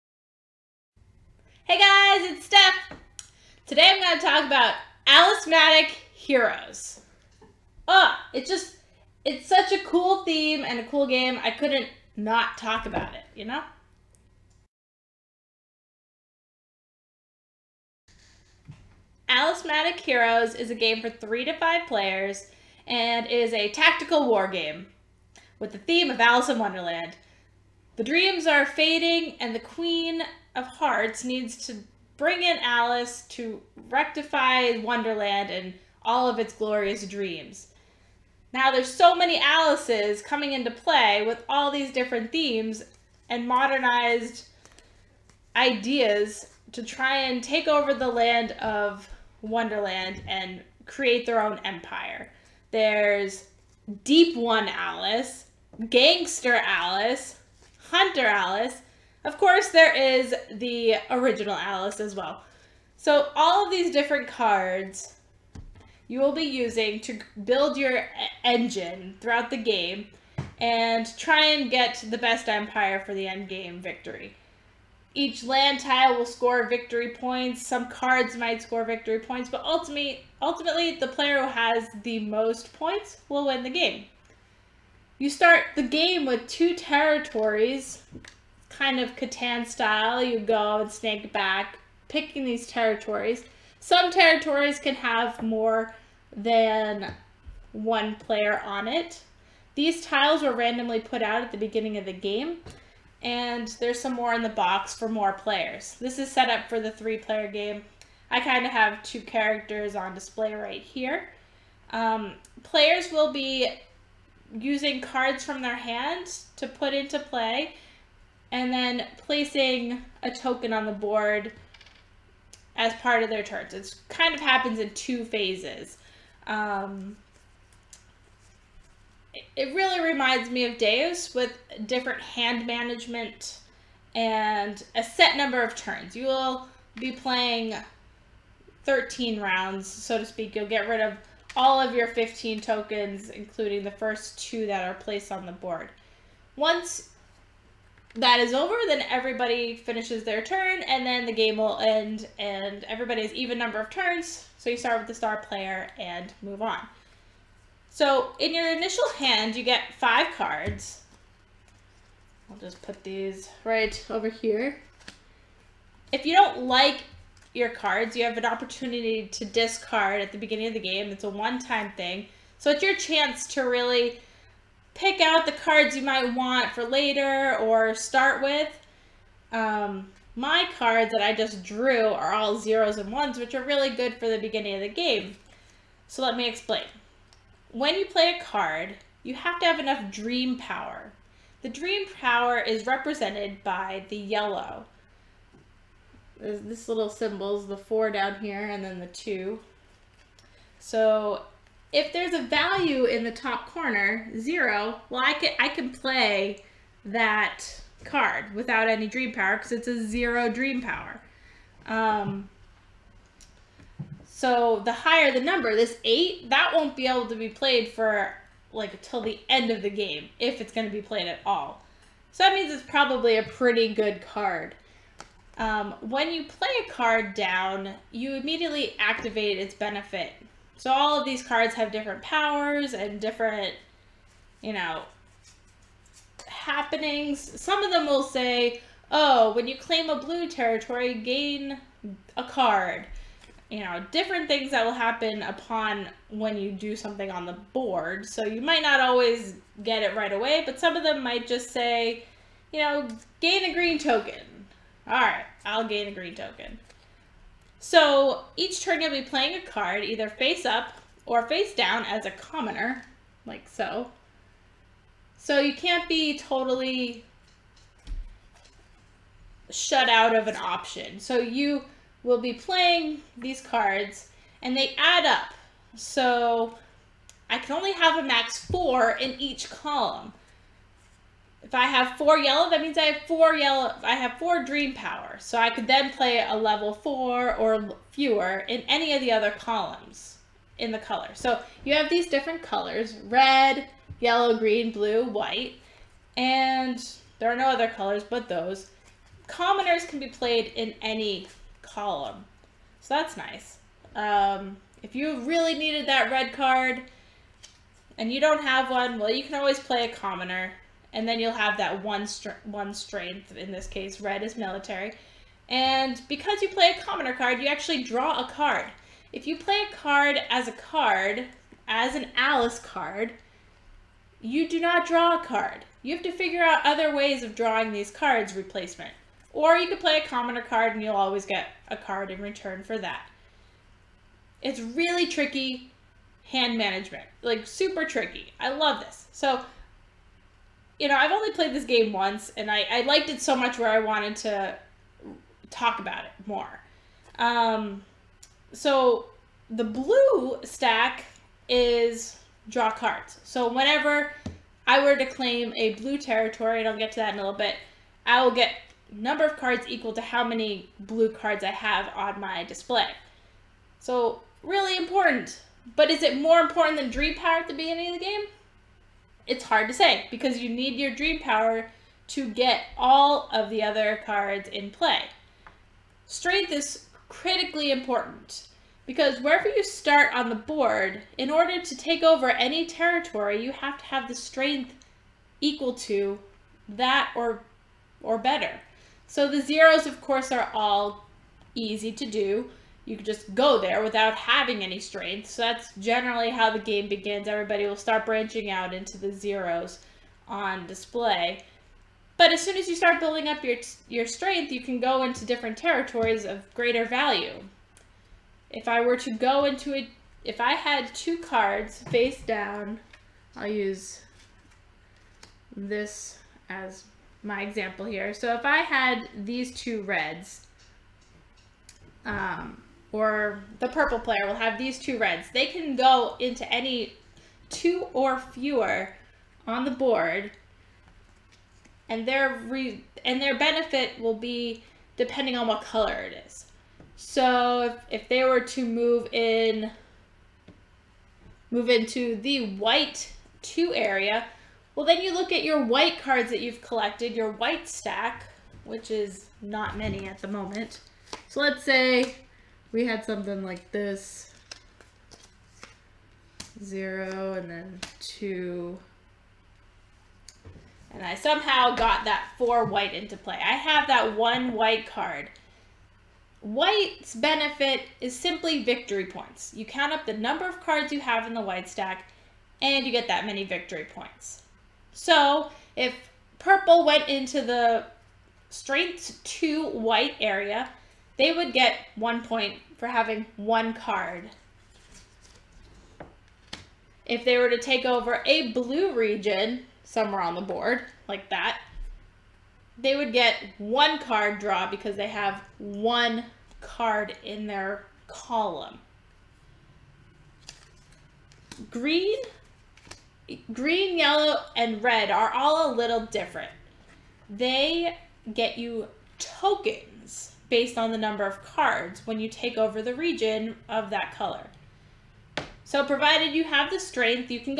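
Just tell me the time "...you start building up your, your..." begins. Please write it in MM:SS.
06:42.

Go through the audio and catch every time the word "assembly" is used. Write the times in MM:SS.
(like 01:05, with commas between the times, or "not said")
not said.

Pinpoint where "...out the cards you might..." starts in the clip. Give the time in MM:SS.
02:55.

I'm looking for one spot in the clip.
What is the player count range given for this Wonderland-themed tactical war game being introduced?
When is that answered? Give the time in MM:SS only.
00:21.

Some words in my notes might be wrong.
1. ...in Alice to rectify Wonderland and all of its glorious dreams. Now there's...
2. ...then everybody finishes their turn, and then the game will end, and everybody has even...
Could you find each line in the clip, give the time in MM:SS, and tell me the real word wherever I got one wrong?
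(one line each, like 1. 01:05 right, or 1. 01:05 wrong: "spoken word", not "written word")
1. 00:32 right
2. 02:28 right.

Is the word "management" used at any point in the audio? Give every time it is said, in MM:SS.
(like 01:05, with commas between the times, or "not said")
02:12, 05:36.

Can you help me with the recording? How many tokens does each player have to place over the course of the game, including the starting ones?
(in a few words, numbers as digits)
15.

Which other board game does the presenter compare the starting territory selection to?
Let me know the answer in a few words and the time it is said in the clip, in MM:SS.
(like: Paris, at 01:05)
Catan, at 01:29.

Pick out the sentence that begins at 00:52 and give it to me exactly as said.
There's Deep One Alice, Gangster Alice, Hunter Alice, of course, there is the original Alice as well.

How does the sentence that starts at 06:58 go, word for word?
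So if I had these two reds, um, or the purple player will have these two reds.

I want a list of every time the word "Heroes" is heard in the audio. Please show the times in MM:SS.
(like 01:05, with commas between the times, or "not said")
00:06, 00:20.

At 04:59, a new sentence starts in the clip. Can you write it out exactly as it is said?
Commoners can be played in any column.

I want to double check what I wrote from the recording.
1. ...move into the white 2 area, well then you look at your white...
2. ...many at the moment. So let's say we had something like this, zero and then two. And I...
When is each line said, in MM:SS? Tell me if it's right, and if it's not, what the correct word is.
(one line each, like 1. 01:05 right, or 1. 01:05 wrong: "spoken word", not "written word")
1. 07:21 right
2. 07:29 right.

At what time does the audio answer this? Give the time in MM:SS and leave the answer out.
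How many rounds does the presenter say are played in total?
02:18.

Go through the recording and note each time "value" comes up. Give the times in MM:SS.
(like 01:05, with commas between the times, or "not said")
03:22, 06:47.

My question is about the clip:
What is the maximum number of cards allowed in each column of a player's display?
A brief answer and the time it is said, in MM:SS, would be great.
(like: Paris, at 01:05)
4, at 04:38.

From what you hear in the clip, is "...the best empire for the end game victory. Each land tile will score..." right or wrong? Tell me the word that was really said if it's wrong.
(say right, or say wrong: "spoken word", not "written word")
right.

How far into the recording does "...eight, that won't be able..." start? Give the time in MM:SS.
03:36.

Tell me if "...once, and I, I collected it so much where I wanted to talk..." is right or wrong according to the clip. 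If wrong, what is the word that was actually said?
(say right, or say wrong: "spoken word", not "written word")
wrong: "liked", not "collected".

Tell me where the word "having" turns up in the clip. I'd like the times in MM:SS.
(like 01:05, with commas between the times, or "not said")
06:34, 08:03.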